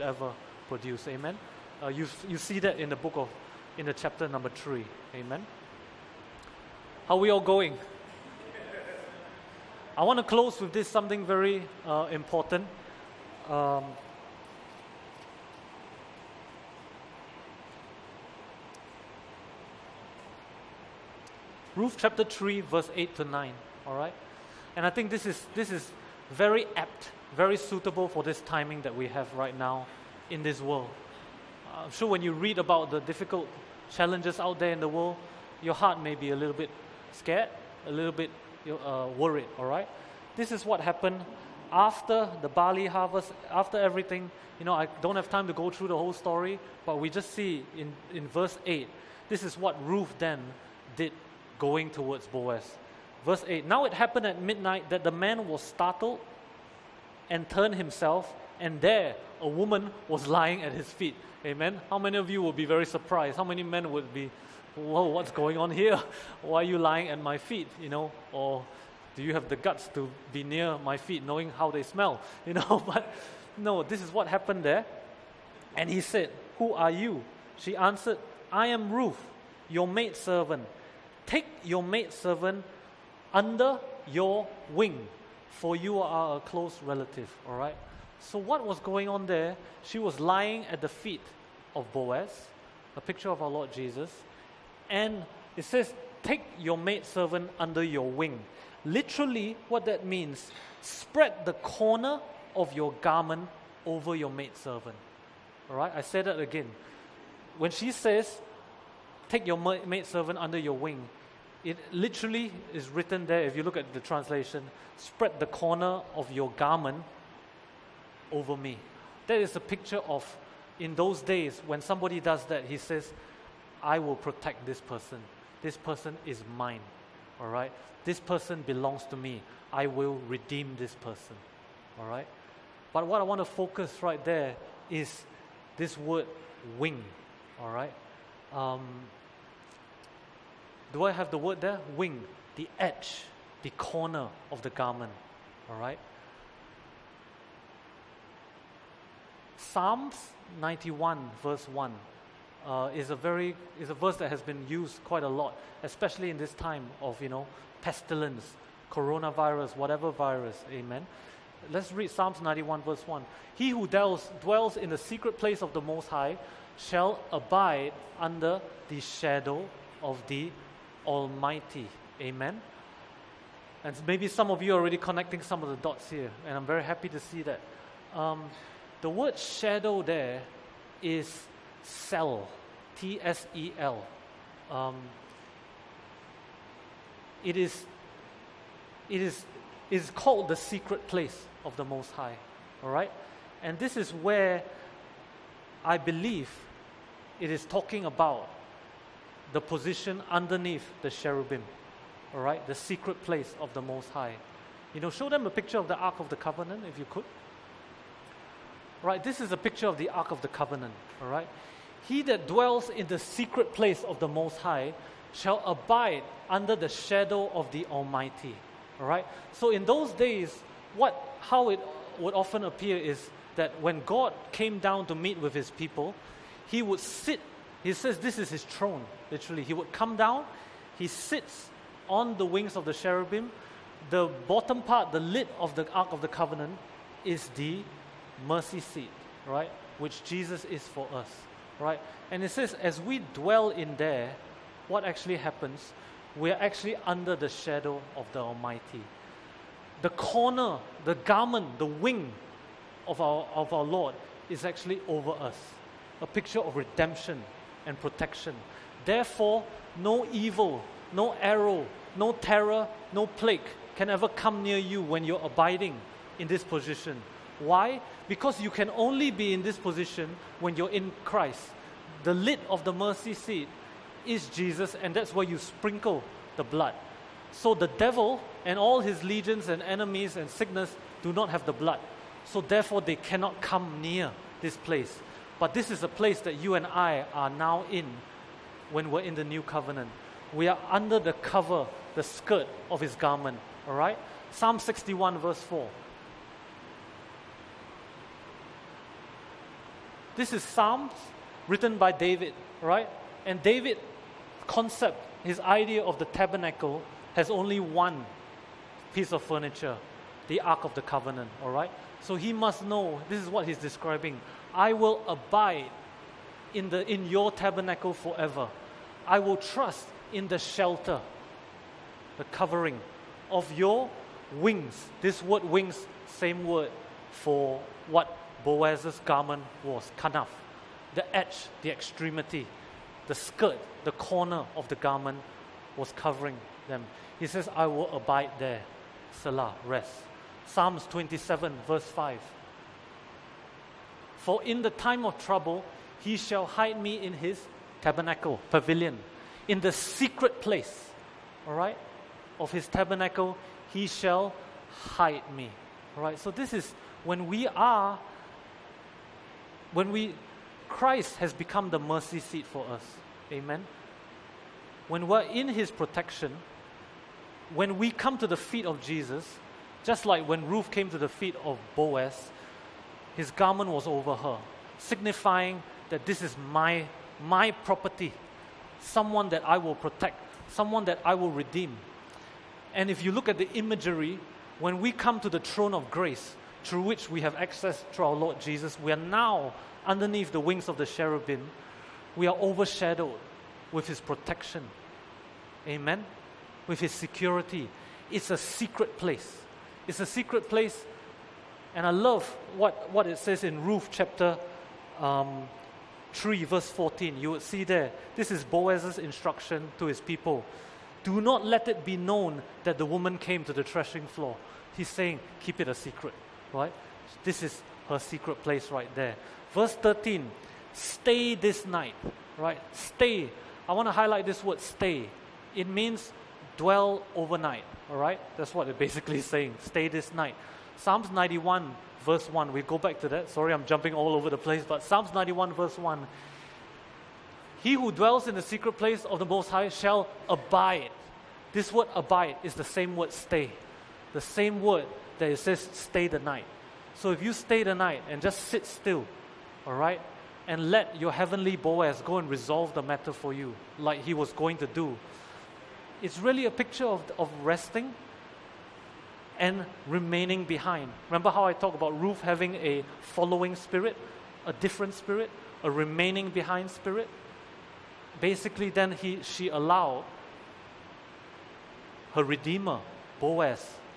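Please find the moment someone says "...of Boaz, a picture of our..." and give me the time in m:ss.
1:31.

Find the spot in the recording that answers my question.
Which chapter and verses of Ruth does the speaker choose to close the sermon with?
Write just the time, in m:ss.
0:21.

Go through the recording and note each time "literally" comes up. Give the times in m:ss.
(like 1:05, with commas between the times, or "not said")
1:38, 1:51, 3:49.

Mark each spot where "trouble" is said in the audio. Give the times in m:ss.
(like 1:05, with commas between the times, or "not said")
5:45.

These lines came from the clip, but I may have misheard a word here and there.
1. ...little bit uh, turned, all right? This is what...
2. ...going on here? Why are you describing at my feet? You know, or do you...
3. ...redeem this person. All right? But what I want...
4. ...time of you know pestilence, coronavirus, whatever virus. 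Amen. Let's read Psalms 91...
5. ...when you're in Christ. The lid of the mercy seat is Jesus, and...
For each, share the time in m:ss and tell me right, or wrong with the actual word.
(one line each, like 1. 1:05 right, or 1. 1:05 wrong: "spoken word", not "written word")
1. 0:37 wrong: "worried", not "turned"
2. 1:05 wrong: "lying", not "describing"
3. 2:10 right
4. 2:36 right
5. 4:30 right.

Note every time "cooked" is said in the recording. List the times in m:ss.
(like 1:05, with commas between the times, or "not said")
not said.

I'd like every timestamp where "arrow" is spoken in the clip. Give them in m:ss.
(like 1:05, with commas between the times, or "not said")
4:21.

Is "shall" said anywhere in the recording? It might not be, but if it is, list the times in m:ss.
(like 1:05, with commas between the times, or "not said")
2:46, 3:35, 5:46, 5:54, 7:19.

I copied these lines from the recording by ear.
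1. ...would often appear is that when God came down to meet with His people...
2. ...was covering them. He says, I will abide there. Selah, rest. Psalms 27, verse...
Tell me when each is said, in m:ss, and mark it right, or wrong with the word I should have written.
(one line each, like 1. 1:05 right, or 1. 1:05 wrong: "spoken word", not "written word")
1. 3:42 right
2. 5:35 right.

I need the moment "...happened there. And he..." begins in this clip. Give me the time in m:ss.
1:14.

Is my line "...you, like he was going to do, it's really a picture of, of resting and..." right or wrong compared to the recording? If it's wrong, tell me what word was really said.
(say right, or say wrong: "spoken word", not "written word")
right.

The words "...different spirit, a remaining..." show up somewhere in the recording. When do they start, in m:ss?
7:44.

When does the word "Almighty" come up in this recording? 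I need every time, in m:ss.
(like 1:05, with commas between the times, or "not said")
2:51, 3:37, 4:08.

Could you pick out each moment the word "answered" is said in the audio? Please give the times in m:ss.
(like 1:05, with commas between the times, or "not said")
1:17.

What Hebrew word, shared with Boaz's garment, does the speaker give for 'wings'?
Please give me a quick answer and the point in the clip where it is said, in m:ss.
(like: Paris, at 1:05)
Kanaf, at 5:30.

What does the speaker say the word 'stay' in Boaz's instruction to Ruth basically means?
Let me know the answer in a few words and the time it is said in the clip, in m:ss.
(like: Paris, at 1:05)
Dwell overnight, at 7:06.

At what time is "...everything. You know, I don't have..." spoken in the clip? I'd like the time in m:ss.
0:43.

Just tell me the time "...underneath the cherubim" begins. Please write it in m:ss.
3:20.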